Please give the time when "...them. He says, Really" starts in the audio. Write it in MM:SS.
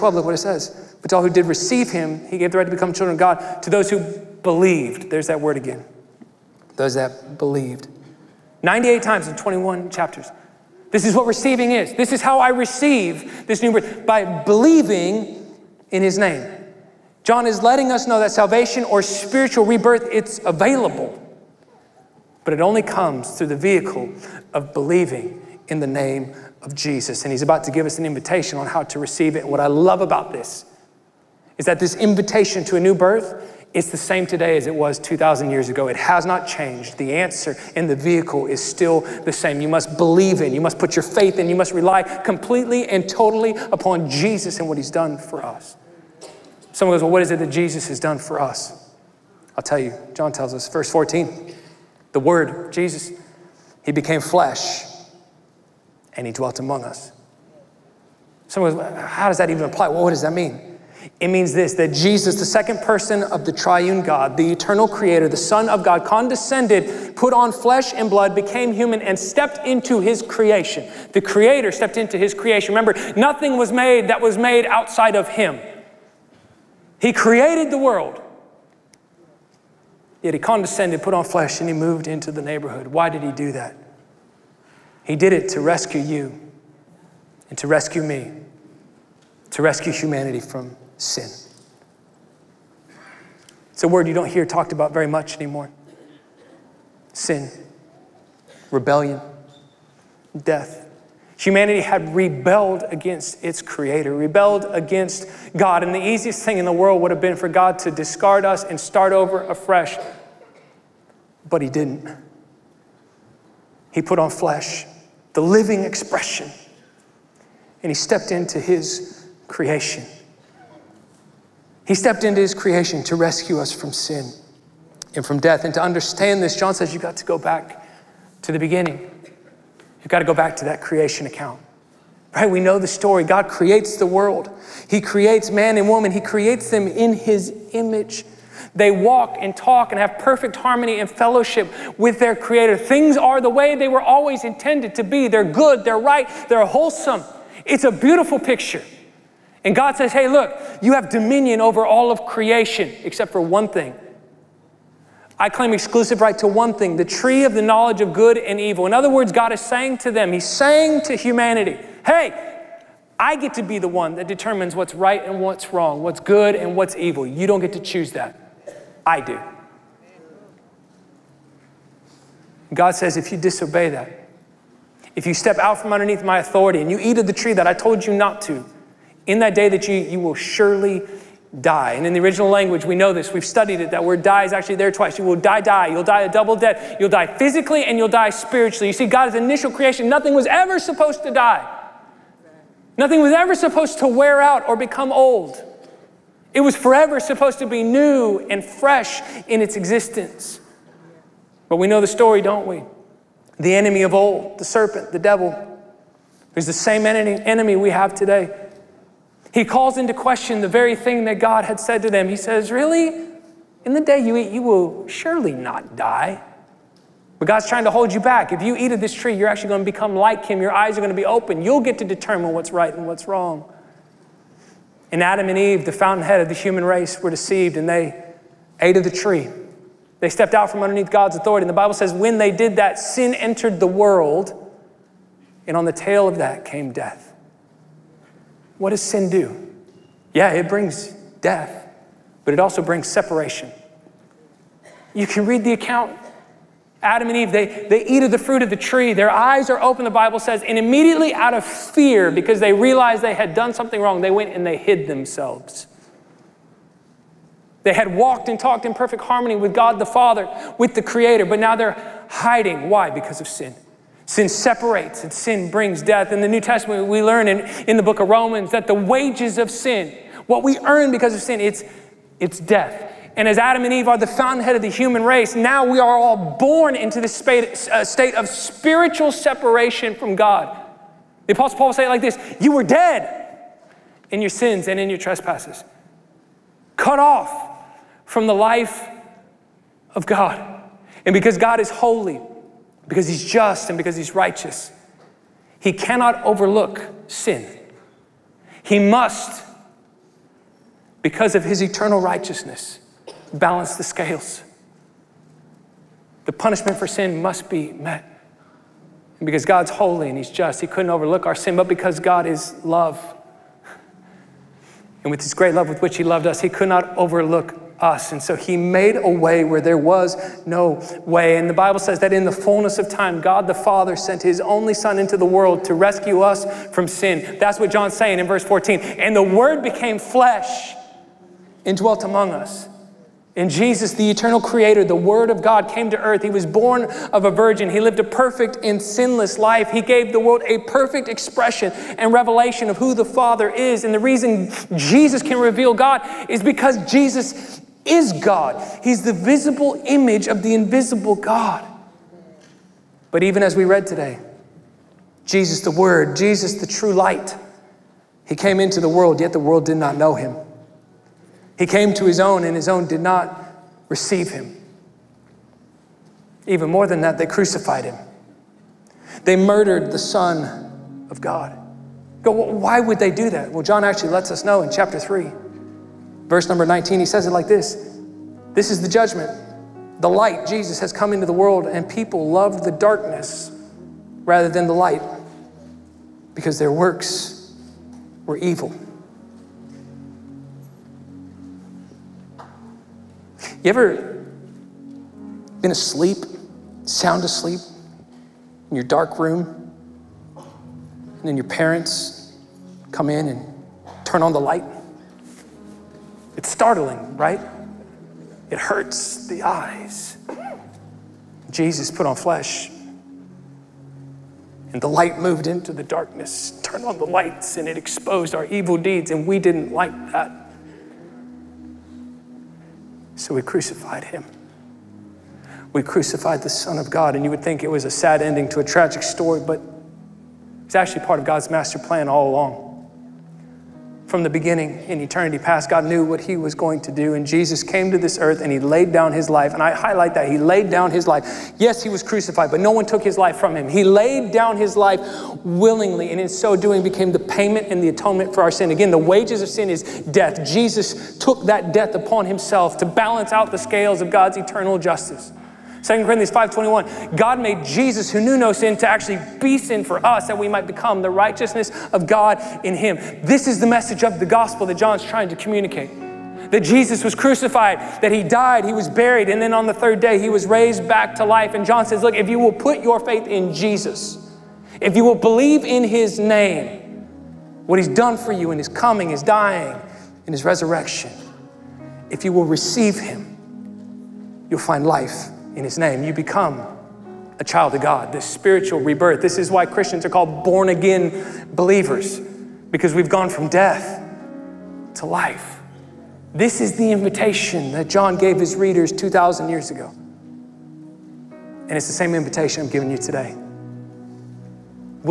03:32.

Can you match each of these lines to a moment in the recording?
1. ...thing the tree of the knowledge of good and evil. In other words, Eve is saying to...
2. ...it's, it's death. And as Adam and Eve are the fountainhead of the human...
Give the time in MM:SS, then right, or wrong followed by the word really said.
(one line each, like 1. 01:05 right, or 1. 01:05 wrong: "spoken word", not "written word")
1. 02:36 wrong: "God", not "Eve"
2. 04:31 right.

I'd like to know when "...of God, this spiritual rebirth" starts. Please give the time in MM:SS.
08:07.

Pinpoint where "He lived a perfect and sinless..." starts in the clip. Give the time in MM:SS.
05:37.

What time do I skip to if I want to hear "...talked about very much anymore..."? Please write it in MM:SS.
01:34.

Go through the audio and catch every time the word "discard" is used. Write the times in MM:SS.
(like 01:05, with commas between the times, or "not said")
01:47.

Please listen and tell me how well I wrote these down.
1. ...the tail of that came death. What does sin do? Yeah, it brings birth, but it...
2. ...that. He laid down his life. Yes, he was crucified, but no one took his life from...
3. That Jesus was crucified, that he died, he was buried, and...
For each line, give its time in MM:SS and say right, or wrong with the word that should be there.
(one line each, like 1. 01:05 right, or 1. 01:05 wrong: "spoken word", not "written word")
1. 03:55 wrong: "death", not "birth"
2. 07:20 right
3. 07:46 right.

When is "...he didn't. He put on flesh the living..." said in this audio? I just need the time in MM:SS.
01:51.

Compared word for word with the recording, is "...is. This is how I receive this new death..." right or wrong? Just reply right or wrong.
wrong.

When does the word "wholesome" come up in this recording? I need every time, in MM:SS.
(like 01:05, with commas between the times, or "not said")
02:26.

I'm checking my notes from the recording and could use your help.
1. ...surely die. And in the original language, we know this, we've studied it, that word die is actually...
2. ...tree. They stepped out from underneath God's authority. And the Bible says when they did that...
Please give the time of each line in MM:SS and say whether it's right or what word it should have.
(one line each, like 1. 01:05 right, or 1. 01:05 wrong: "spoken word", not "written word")
1. 03:00 right
2. 03:49 right.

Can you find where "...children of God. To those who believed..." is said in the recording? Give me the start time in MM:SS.
00:02.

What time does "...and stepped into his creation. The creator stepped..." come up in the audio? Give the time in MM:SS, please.
01:09.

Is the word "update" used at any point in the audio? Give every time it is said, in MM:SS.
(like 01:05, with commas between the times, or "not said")
not said.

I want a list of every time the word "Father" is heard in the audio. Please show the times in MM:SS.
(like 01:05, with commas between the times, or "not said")
04:20, 05:23, 05:43.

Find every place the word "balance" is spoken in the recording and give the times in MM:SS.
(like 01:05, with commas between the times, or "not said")
05:03, 07:33.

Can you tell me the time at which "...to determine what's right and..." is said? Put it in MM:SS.
03:41.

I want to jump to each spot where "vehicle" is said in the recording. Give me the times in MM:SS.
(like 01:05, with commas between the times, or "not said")
00:23, 00:37.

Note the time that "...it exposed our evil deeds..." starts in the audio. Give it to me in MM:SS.
06:57.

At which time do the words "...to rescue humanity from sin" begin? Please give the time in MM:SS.
01:29.